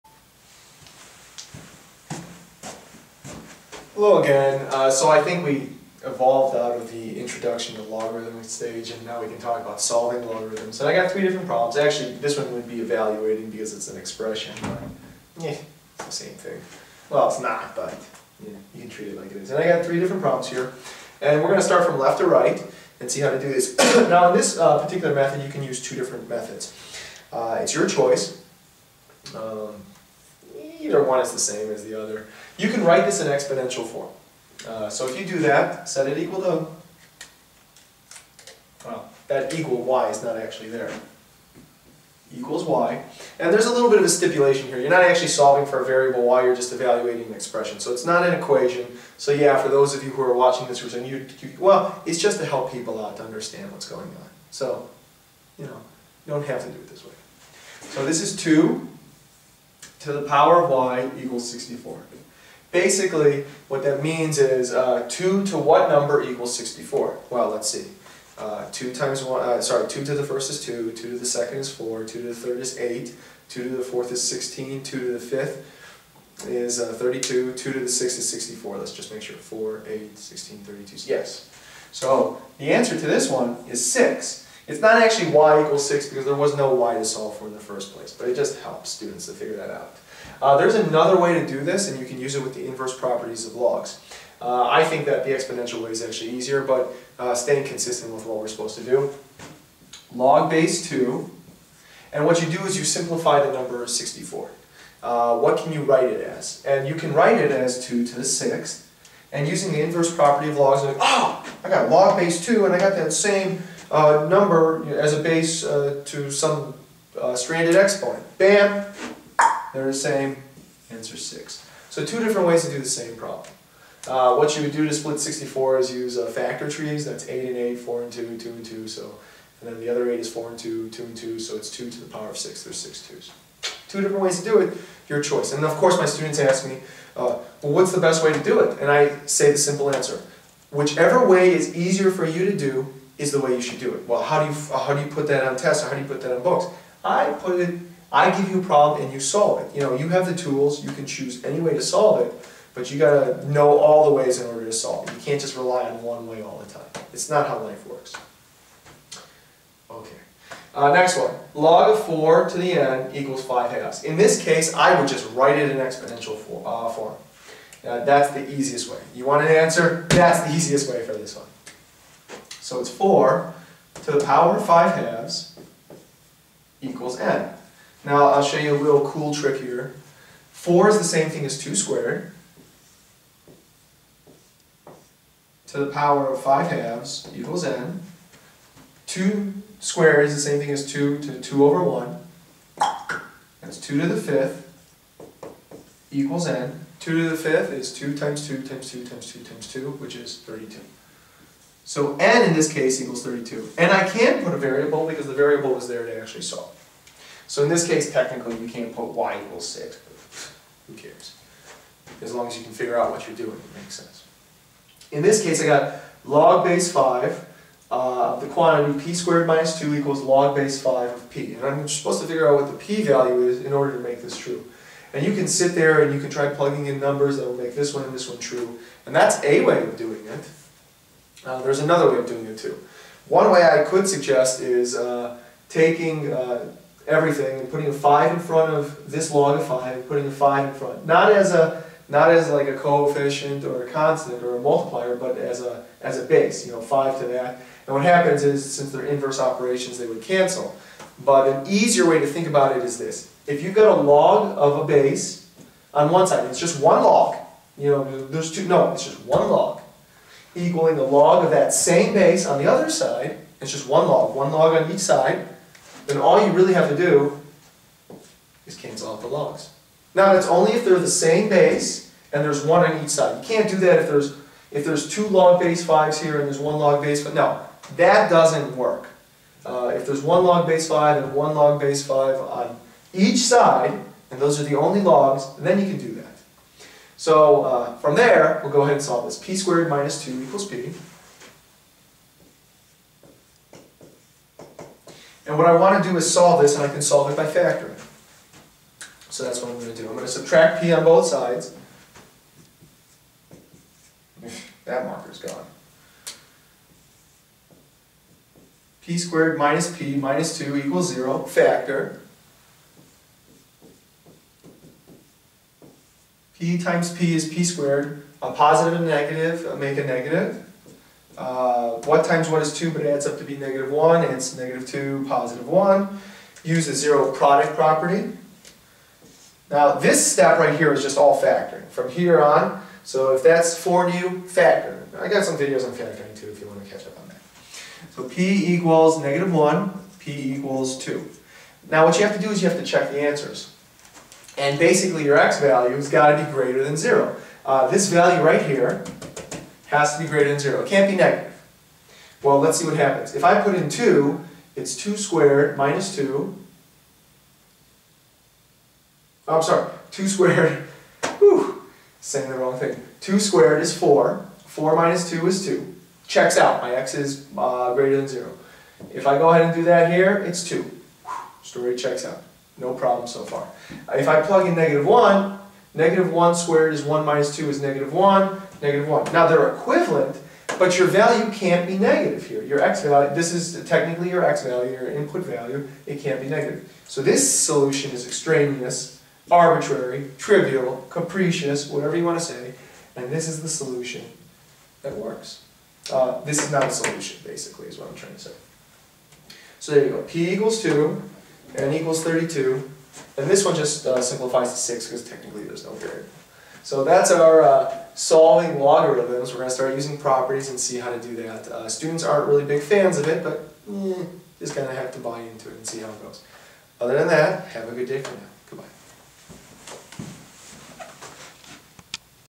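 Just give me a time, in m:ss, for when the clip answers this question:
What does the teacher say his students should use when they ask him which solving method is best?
2:20.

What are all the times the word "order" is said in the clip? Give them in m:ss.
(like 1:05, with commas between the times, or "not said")
2:34, 3:43.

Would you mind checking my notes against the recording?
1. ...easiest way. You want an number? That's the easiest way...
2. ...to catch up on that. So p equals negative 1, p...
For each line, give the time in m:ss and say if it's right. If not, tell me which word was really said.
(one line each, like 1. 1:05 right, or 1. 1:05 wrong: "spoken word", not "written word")
1. 2:48 wrong: "answer", not "number"
2. 5:36 right.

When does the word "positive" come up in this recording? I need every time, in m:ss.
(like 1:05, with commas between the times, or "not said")
5:18, 5:25.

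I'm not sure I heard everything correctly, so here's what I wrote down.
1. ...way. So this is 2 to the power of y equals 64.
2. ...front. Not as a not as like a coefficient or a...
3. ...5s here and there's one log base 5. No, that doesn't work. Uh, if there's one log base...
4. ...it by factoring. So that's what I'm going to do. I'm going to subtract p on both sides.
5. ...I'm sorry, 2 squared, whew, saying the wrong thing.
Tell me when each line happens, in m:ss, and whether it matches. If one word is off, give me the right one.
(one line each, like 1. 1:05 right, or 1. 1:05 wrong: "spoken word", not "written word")
1. 0:57 right
2. 4:00 right
3. 4:35 right
4. 4:57 right
5. 5:59 right.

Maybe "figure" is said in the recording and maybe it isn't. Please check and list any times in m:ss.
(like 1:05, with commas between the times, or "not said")
1:29, 3:32, 3:42.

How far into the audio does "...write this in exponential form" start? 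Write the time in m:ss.
0:32.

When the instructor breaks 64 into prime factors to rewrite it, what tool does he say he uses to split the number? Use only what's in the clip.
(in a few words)
factor trees.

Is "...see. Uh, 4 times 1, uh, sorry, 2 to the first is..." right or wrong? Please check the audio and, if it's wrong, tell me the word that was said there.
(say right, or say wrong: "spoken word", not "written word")
wrong: "2", not "4".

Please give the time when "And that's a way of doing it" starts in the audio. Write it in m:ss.
3:49.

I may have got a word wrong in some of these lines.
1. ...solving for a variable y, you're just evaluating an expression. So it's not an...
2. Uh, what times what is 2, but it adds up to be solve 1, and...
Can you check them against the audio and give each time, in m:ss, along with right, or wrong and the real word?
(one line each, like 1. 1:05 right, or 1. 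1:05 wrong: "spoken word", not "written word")
1. 0:45 right
2. 5:21 wrong: "negative", not "solve".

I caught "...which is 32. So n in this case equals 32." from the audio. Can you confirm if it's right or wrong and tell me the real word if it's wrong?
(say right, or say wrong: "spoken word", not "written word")
right.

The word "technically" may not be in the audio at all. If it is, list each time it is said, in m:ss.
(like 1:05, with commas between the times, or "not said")
3:28, 6:23, 6:45.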